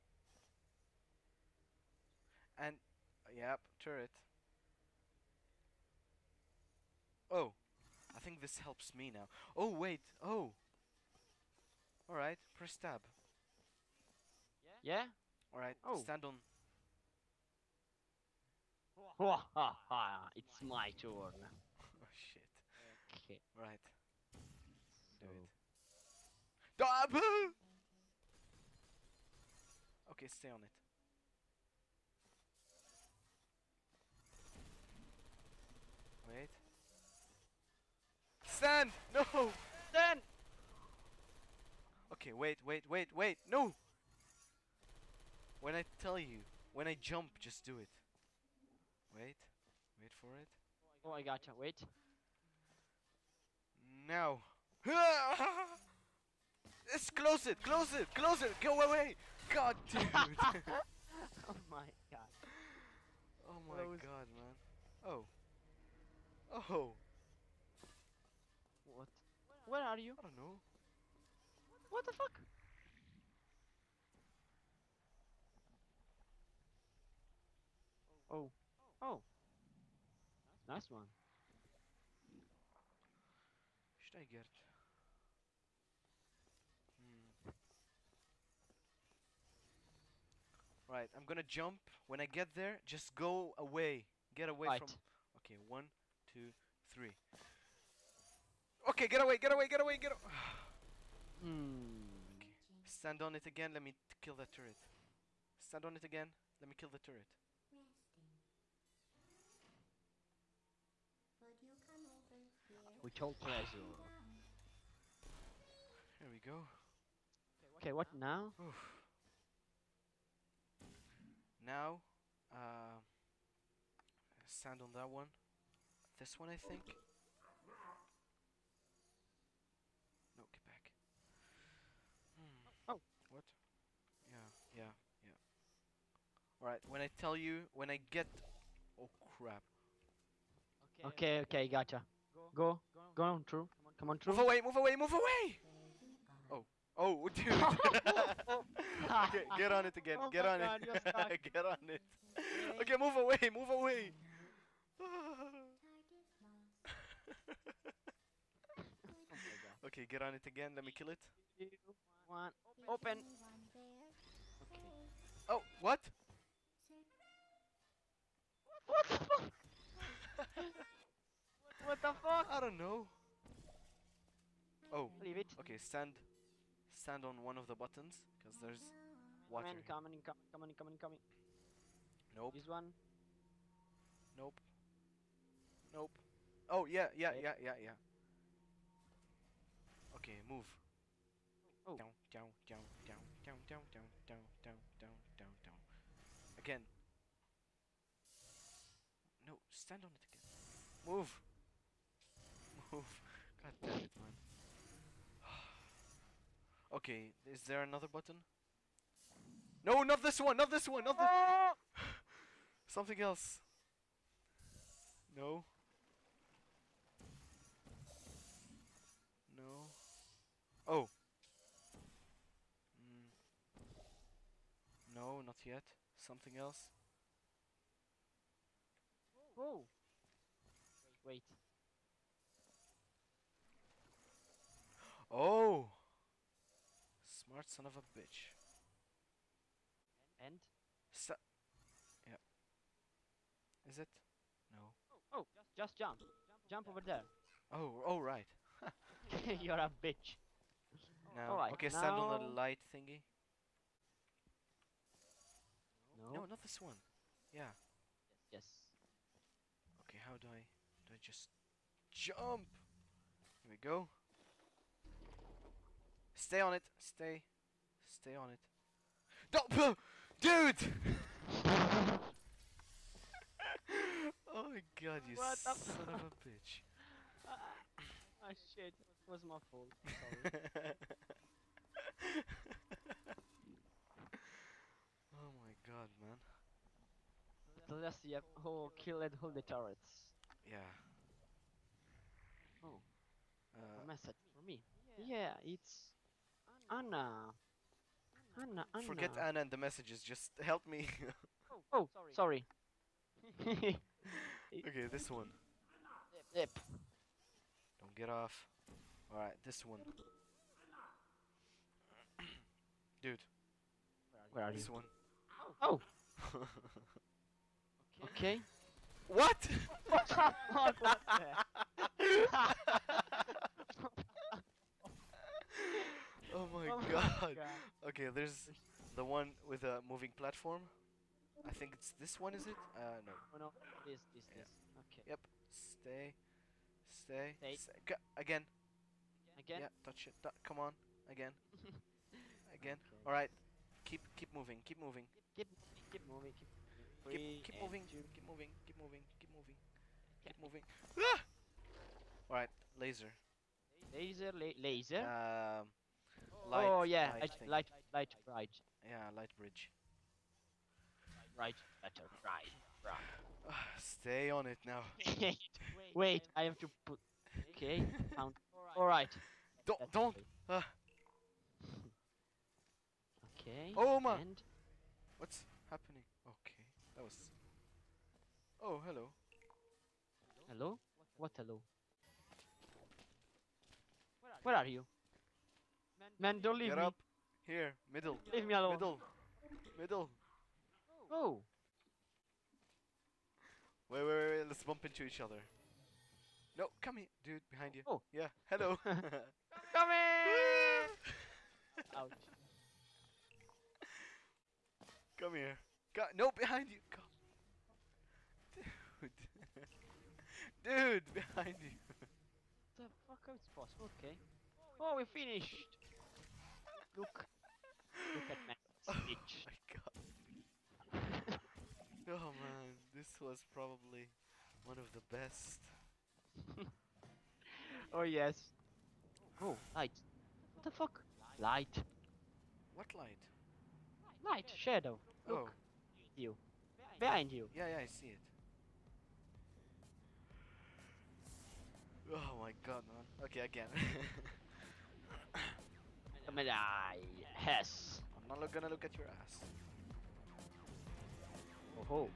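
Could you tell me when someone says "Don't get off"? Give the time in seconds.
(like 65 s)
307 s.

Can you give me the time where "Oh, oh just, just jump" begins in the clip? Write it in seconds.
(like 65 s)
245 s.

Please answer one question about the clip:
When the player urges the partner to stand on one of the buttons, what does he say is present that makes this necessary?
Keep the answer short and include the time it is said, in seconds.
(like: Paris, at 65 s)
water, at 179 s.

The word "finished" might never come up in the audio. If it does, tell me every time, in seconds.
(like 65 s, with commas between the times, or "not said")
415 s.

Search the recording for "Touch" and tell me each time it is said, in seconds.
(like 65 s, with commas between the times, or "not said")
340 s.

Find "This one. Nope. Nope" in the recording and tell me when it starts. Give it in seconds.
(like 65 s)
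182 s.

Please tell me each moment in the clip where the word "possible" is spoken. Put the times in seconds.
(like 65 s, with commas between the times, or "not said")
413 s.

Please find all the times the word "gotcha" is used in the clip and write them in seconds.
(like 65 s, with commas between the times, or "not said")
51 s, 141 s.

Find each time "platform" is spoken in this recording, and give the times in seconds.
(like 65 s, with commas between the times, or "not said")
330 s.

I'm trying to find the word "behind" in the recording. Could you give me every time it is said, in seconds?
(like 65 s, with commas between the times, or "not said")
397 s, 406 s, 411 s, 437 s.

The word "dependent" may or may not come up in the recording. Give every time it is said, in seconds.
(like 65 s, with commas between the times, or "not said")
not said.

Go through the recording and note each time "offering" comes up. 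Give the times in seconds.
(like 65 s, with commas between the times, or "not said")
not said.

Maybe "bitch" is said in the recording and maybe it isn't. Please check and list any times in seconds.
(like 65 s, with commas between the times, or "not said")
238 s, 250 s, 276 s.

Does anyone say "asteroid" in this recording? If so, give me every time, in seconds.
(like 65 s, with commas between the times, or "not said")
not said.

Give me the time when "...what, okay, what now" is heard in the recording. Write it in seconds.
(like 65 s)
117 s.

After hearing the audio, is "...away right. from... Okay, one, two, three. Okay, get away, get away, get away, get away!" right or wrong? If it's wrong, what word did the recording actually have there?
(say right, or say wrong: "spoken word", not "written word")
right.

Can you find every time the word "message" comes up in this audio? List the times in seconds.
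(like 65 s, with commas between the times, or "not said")
294 s, 299 s.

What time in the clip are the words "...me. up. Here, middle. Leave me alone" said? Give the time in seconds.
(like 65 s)
386 s.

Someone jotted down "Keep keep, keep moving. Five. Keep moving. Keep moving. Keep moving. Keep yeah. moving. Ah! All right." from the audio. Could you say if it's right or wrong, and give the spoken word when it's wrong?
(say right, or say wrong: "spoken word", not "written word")
wrong: "Two", not "Five".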